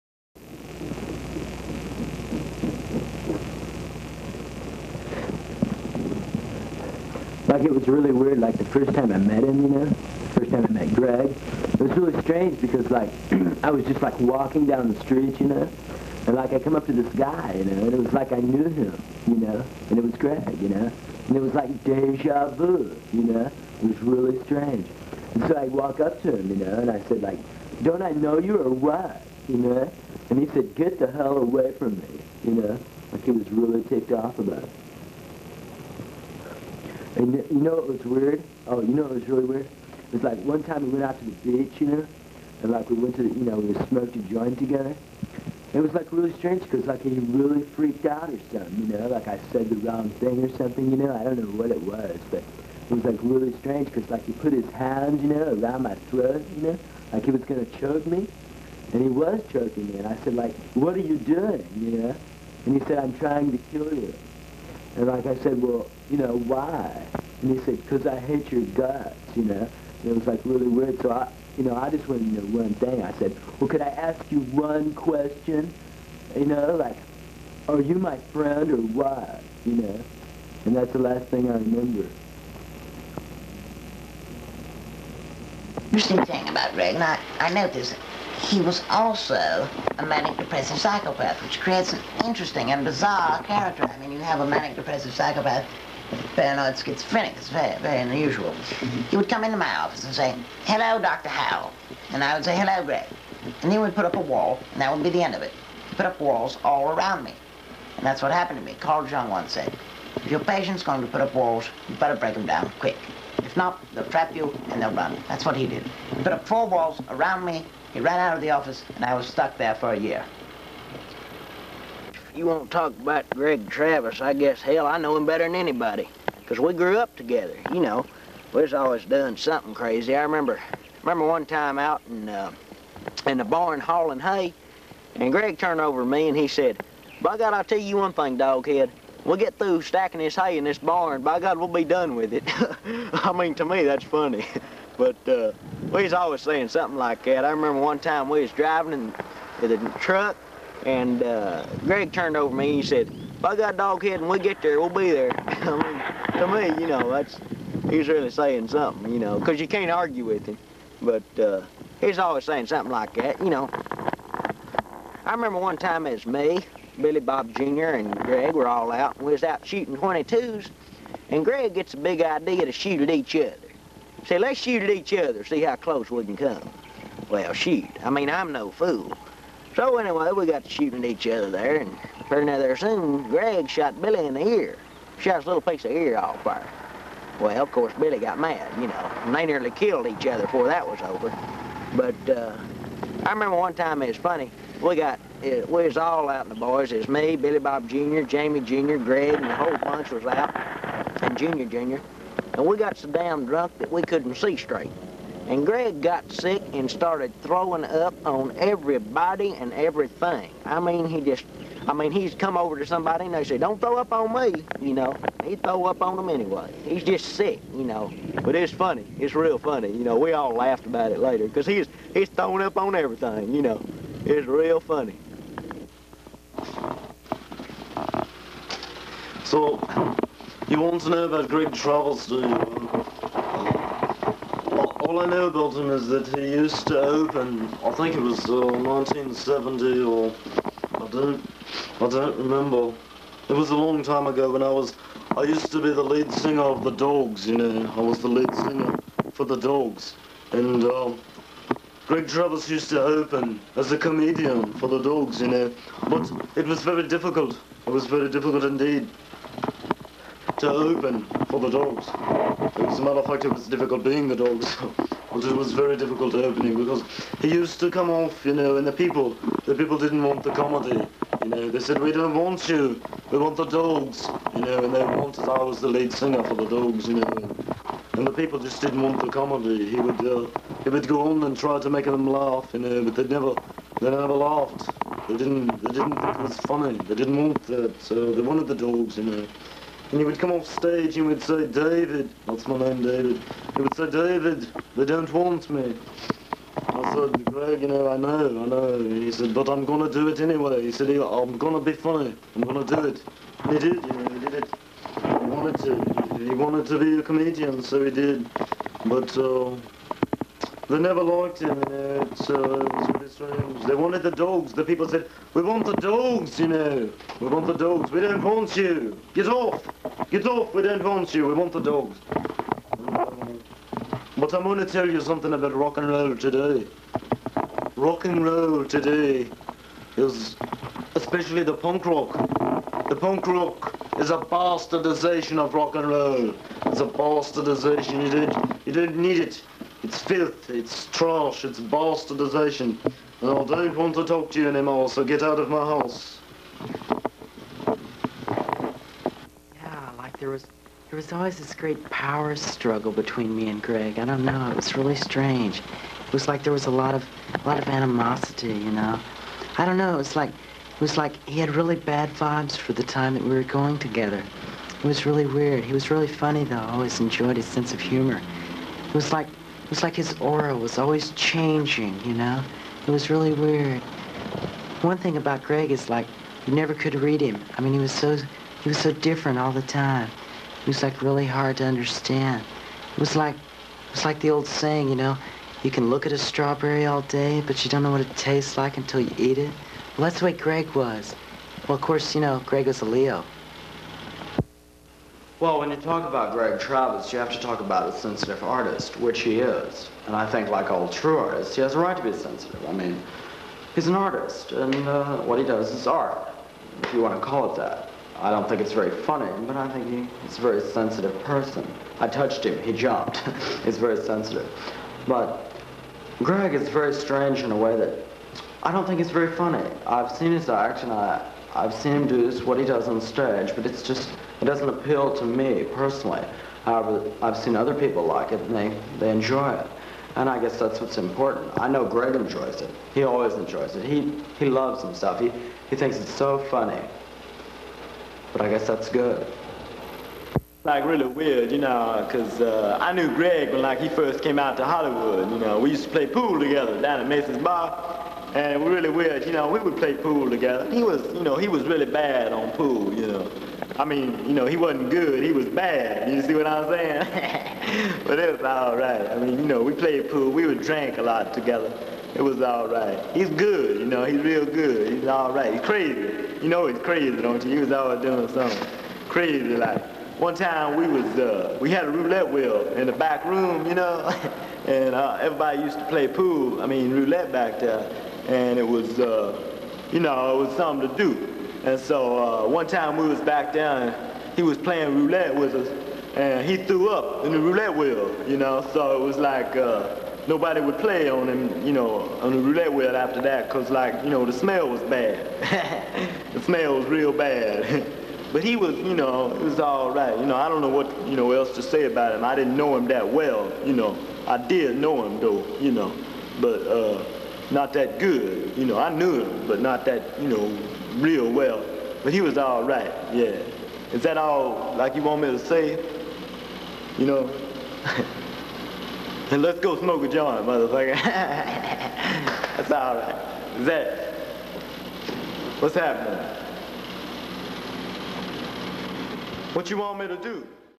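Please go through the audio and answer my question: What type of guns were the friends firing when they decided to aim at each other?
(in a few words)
22s.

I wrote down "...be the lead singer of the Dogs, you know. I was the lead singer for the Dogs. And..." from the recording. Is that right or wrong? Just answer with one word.
right.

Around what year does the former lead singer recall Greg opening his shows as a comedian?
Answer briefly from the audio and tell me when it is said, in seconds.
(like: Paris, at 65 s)
1970, at 238 s.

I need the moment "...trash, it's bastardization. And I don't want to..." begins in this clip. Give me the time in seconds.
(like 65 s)
341 s.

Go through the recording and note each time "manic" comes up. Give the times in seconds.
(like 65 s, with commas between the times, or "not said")
90 s, 94 s.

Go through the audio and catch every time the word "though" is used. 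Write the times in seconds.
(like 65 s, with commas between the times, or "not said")
366 s, 505 s.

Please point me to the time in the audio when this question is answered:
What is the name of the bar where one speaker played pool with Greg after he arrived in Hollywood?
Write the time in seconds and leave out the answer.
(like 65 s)
447 s.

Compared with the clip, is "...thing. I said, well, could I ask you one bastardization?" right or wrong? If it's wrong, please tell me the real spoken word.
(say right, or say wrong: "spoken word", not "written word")
wrong: "question", not "bastardization".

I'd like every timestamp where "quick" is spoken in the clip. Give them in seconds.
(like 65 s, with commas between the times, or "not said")
112 s.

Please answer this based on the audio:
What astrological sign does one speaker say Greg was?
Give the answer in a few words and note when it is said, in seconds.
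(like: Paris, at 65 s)
Leo, at 393 s.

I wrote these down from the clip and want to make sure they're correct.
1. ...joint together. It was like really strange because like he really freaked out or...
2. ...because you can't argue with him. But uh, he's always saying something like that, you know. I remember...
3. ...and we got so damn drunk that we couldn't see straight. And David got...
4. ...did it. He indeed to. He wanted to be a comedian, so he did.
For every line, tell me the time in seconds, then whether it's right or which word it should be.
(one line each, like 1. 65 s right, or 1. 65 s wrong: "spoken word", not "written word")
1. 44 s right
2. 159 s right
3. 202 s wrong: "Greg", not "David"
4. 304 s wrong: "wanted", not "indeed".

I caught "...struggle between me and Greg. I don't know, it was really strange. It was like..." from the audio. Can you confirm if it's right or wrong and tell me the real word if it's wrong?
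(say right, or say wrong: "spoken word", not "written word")
right.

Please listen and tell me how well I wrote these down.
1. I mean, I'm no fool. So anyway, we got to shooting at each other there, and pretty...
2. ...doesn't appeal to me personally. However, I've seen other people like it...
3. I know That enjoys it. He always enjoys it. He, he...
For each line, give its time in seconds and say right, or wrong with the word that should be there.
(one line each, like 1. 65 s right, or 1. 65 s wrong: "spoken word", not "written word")
1. 178 s right
2. 424 s right
3. 431 s wrong: "Greg", not "That".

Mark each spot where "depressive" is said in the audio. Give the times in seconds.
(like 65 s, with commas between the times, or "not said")
90 s, 94 s.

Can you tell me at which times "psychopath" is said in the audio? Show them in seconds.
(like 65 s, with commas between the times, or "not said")
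90 s, 95 s.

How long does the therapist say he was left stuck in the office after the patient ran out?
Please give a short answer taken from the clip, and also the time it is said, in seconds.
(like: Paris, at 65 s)
a year, at 119 s.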